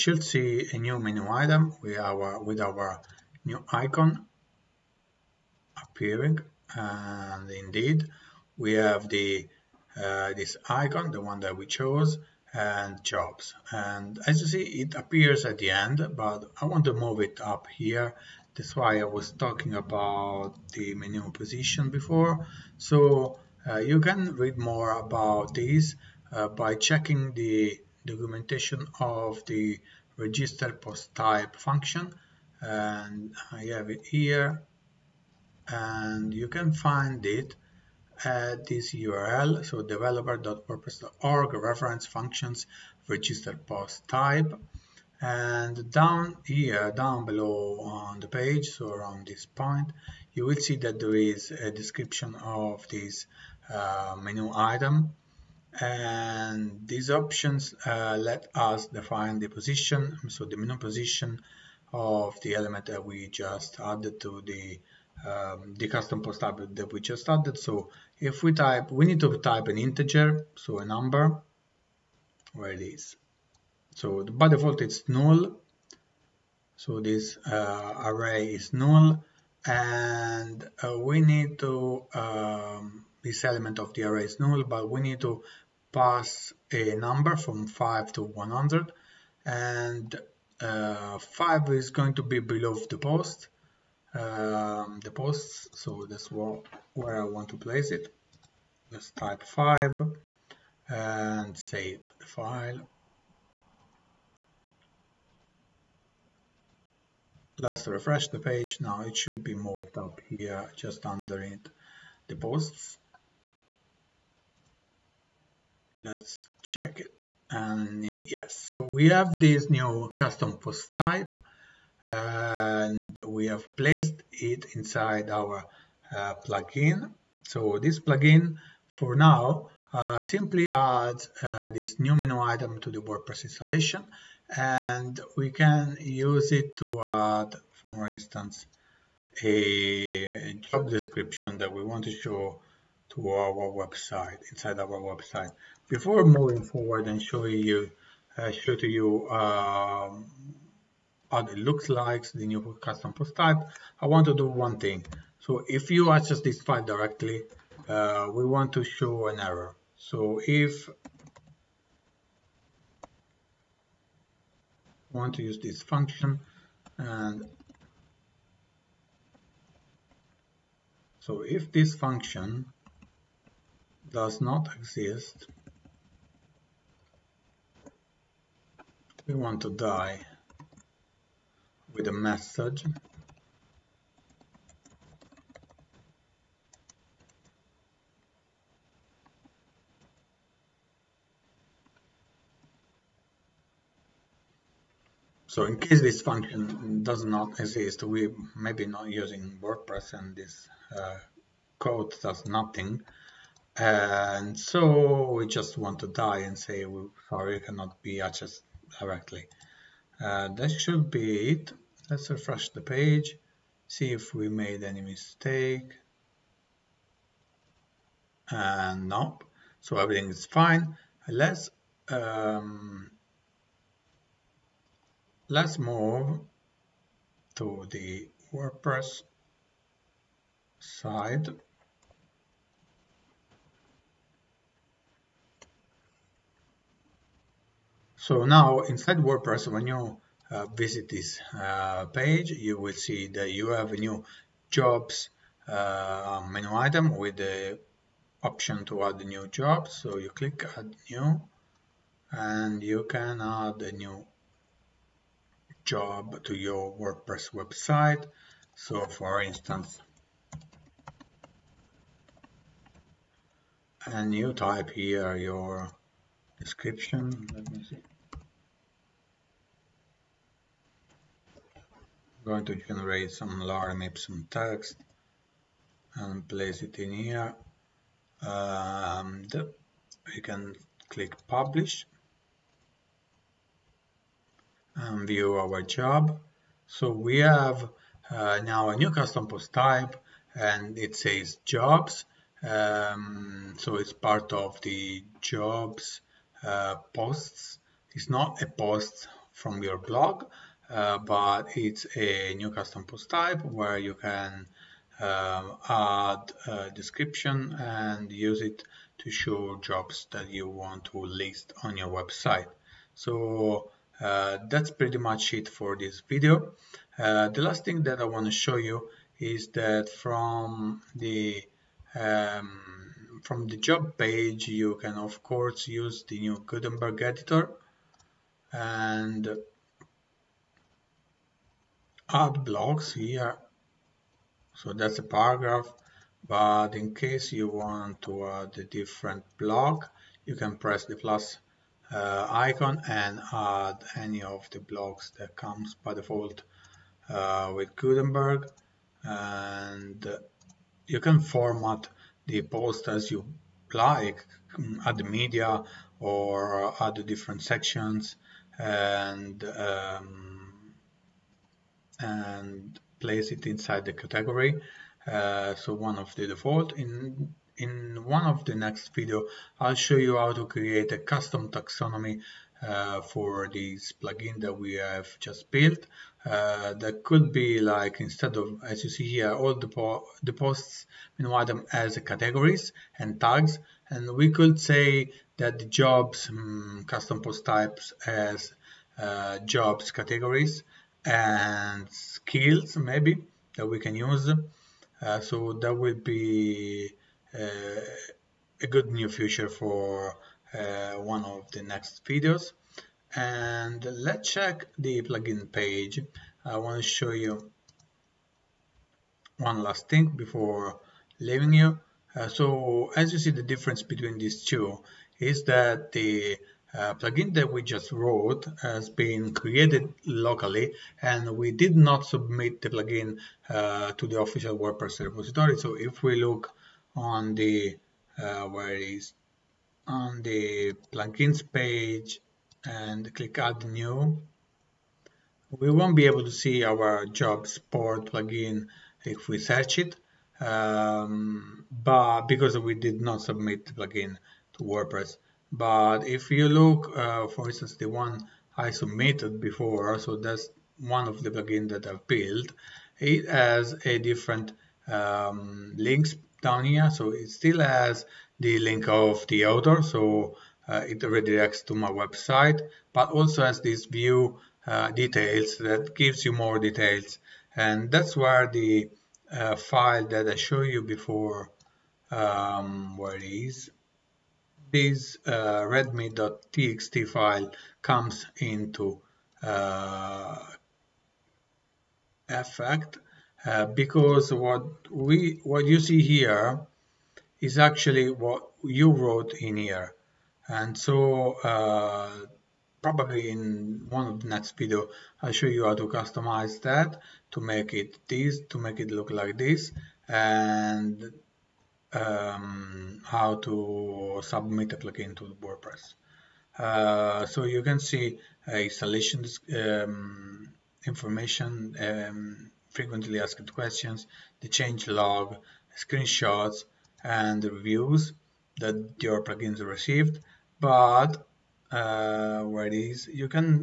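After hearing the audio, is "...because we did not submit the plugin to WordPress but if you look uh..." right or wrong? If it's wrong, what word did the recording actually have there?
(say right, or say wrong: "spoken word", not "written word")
right.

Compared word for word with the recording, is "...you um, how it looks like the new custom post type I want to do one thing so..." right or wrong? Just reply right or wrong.
right.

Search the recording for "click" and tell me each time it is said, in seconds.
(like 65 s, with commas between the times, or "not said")
250 s, 281 s, 433 s.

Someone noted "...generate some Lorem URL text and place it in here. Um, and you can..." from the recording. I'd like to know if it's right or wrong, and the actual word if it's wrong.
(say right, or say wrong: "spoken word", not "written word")
wrong: "Ipsum", not "URL".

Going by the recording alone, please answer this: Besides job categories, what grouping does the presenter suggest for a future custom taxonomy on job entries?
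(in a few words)
skills.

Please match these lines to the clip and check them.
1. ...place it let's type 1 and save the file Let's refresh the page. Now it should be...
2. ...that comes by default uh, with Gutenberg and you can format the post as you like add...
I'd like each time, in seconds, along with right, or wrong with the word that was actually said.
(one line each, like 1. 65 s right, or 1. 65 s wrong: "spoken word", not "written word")
1. 97 s wrong: "5", not "1"
2. 345 s right.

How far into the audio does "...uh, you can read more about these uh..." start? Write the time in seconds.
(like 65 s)
23 s.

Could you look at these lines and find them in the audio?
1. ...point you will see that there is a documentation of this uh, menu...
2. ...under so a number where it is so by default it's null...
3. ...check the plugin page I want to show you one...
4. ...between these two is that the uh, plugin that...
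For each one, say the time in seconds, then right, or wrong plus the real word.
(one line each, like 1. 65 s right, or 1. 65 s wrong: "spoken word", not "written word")
1. 49 s wrong: "description", not "documentation"
2. 69 s wrong: "integer", not "under"
3. 404 s right
4. 414 s right.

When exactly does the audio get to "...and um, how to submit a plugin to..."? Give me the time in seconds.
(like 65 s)
500 s.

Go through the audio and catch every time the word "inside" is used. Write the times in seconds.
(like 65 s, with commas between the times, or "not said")
124 s, 144 s, 238 s, 363 s.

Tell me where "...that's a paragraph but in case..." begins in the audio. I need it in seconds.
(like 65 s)
334 s.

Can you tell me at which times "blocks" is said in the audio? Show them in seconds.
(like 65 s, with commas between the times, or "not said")
332 s, 339 s, 344 s.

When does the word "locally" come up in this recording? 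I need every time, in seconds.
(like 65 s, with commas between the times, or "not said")
420 s.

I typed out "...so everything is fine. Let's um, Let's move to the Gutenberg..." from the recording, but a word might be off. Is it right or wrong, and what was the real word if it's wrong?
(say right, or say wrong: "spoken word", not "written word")
wrong: "WordPress", not "Gutenberg".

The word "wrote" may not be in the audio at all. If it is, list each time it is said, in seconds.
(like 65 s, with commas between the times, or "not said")
418 s, 489 s.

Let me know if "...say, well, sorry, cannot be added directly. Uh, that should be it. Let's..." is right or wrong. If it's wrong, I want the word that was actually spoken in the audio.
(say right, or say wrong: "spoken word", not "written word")
wrong: "accessed", not "added".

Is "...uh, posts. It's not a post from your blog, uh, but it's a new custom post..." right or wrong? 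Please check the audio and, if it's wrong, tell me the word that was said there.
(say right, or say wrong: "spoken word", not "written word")
right.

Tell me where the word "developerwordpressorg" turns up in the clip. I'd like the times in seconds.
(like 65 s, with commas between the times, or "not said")
39 s.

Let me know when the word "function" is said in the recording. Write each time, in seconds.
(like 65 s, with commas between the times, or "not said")
31 s, 42 s, 165 s, 171 s, 196 s.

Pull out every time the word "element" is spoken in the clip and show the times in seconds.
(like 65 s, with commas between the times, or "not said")
62 s, 83 s.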